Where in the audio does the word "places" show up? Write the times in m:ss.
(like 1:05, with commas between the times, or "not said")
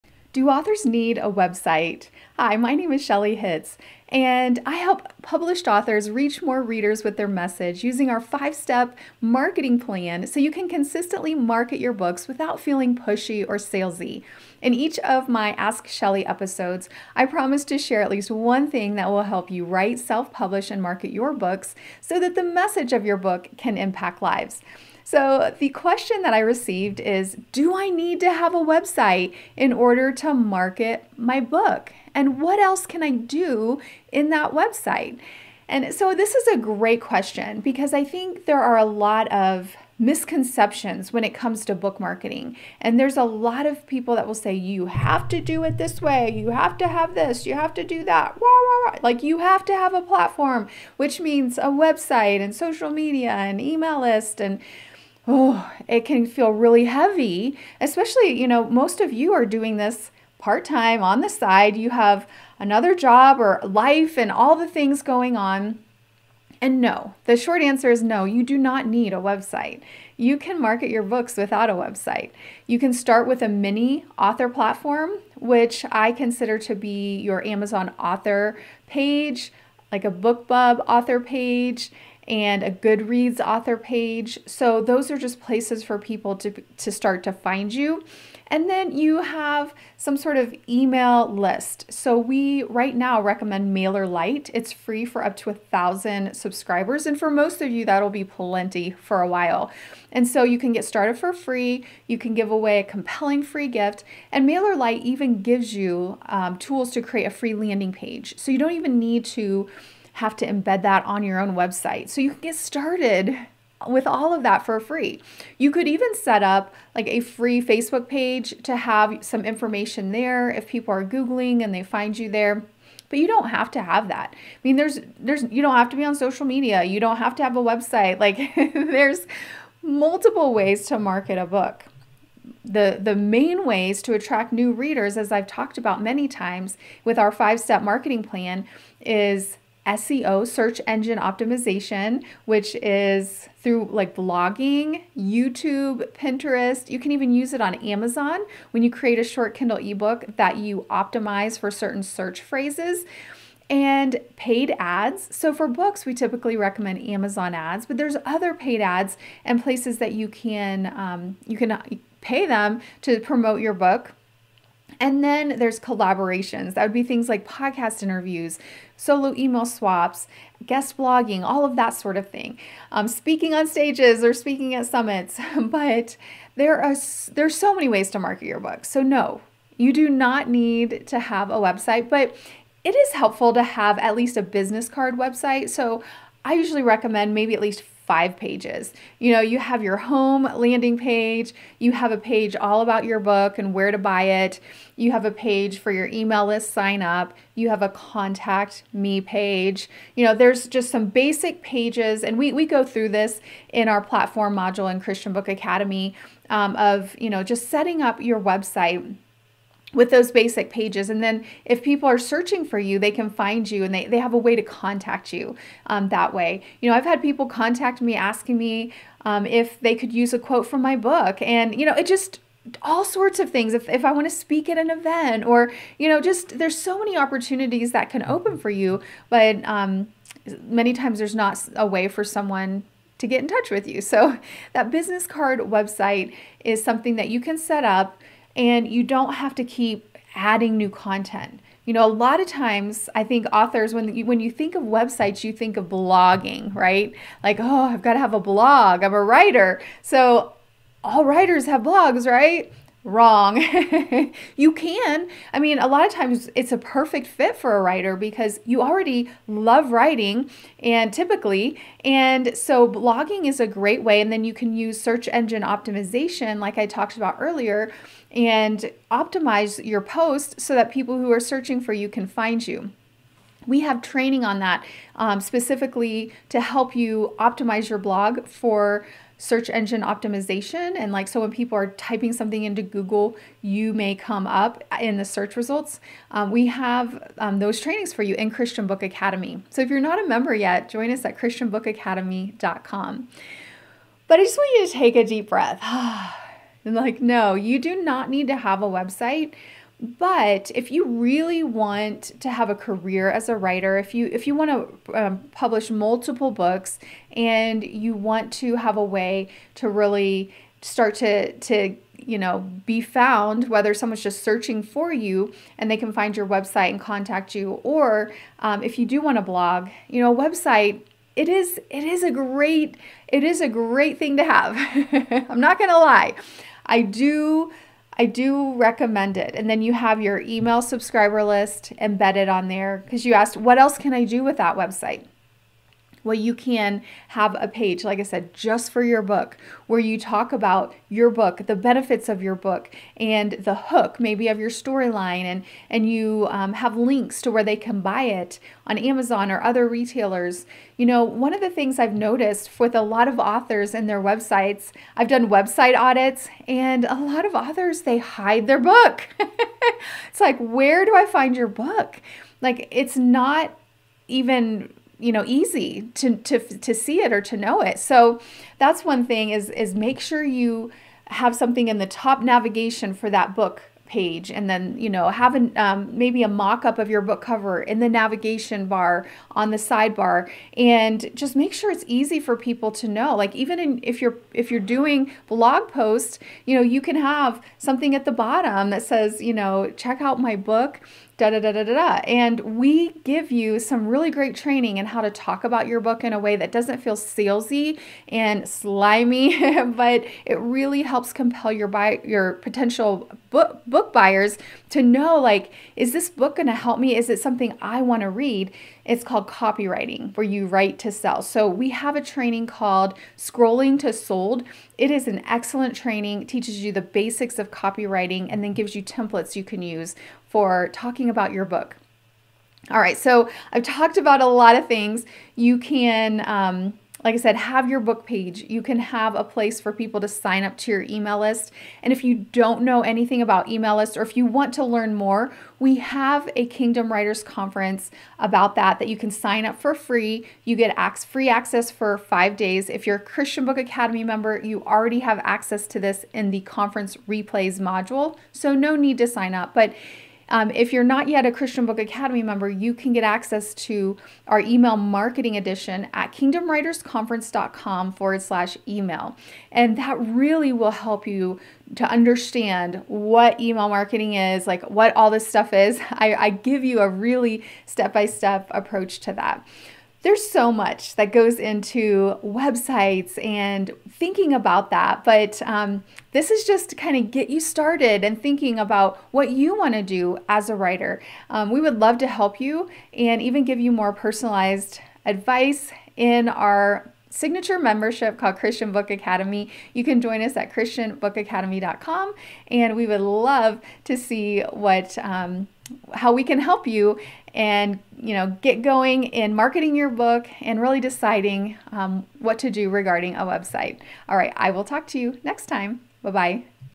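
1:25, 2:39, 7:09.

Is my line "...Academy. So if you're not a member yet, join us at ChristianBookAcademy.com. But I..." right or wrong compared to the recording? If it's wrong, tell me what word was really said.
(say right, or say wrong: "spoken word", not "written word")
right.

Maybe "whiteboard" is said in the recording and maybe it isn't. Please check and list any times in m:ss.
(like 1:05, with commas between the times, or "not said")
not said.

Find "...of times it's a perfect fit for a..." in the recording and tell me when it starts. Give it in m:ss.
4:16.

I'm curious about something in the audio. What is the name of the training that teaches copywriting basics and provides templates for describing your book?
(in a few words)
Scrolling to Sold.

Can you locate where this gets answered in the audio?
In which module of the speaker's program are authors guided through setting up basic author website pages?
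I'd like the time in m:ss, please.
3:24.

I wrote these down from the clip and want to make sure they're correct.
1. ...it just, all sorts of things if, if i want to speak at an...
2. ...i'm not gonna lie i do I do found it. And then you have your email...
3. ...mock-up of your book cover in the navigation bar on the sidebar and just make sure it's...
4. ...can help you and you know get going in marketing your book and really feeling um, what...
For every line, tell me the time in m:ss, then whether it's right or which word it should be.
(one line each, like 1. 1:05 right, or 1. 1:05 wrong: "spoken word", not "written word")
1. 3:41 right
2. 5:25 wrong: "recommend", not "found"
3. 6:16 right
4. 8:16 wrong: "deciding", not "feeling".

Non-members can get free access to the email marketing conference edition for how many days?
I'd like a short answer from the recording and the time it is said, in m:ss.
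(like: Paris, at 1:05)
5, at 7:22.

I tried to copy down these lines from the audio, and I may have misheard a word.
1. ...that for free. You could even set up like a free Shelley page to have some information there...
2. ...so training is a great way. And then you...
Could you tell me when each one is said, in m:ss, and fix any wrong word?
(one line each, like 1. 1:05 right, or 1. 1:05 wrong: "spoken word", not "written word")
1. 1:54 wrong: "Facebook", not "Shelley"
2. 4:22 wrong: "blogging", not "training".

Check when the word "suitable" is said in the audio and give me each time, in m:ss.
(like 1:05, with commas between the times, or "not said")
not said.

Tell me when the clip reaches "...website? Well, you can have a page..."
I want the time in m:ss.
5:34.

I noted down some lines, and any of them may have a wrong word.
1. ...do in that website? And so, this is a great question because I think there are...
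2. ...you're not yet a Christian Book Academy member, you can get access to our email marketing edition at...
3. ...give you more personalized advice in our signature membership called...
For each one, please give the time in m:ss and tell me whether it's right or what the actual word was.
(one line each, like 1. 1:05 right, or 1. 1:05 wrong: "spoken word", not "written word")
1. 0:33 right
2. 7:30 right
3. 8:03 right.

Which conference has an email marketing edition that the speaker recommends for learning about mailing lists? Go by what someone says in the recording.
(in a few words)
Kingdom Writers Conference.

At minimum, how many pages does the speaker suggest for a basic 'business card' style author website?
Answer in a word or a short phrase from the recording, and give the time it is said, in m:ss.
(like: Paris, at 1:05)
5, at 3:08.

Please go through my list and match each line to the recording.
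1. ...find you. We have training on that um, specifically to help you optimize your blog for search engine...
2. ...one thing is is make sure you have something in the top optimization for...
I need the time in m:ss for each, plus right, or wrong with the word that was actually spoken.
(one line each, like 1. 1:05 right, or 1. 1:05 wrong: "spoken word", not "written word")
1. 4:32 right
2. 6:09 wrong: "navigation", not "optimization".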